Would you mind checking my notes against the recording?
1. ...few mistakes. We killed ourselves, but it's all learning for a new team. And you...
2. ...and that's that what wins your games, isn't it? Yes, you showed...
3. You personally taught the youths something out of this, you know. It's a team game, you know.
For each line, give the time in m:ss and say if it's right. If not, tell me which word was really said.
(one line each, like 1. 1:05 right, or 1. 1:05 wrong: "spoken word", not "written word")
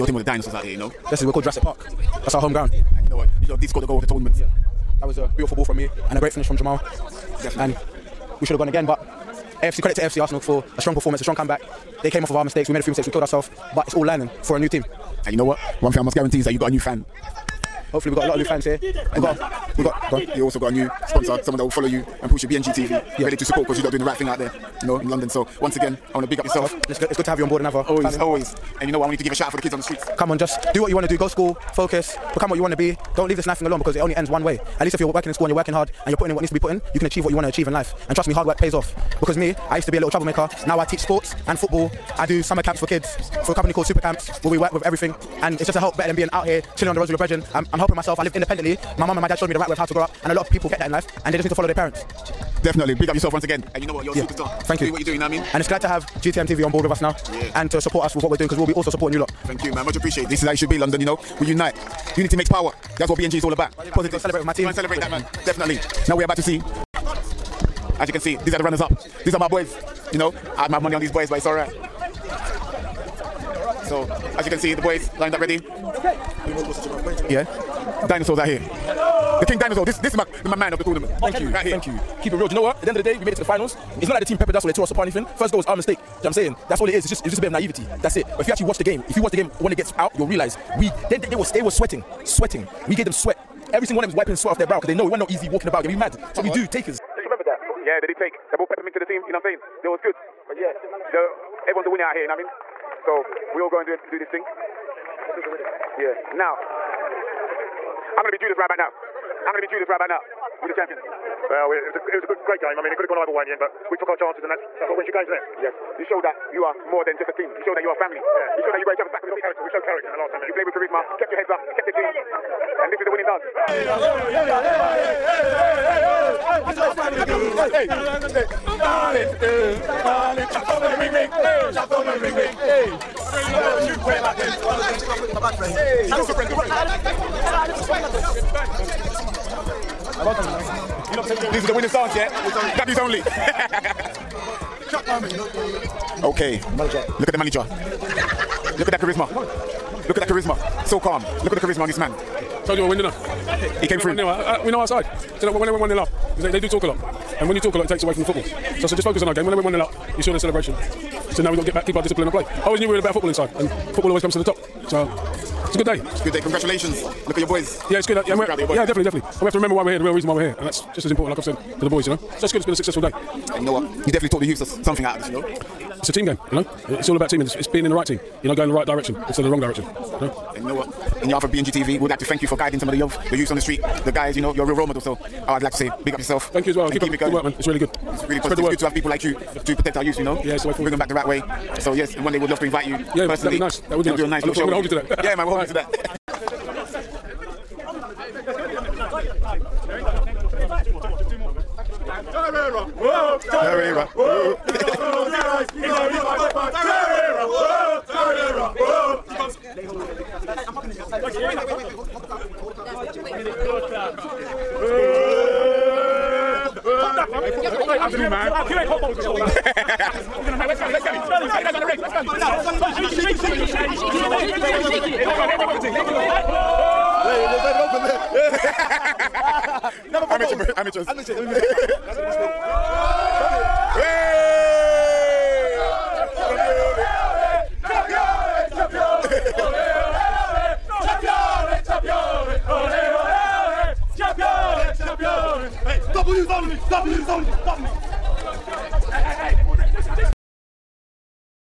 1. 0:12 right
2. 1:54 right
3. 2:54 wrong: "definitely", not "personally".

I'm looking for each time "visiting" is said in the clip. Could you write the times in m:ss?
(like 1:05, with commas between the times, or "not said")
not said.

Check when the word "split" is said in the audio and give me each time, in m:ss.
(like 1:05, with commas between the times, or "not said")
3:52.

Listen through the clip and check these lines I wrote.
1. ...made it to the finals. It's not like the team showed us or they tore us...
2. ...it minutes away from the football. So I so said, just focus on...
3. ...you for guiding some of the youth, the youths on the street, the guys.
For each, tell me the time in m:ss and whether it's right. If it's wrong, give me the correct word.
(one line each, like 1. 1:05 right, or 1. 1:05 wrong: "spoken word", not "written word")
1. 1:23 wrong: "peppered", not "showed"
2. 2:37 wrong: "takes", not "minutes"
3. 3:02 right.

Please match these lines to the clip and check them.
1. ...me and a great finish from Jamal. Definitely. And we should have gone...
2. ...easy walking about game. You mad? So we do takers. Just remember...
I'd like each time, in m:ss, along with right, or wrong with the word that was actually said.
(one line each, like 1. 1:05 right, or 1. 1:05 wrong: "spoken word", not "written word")
1. 0:05 right
2. 1:35 right.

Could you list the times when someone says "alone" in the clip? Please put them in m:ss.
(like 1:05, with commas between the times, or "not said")
0:33.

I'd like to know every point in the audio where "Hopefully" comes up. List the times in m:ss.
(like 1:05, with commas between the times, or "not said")
0:17.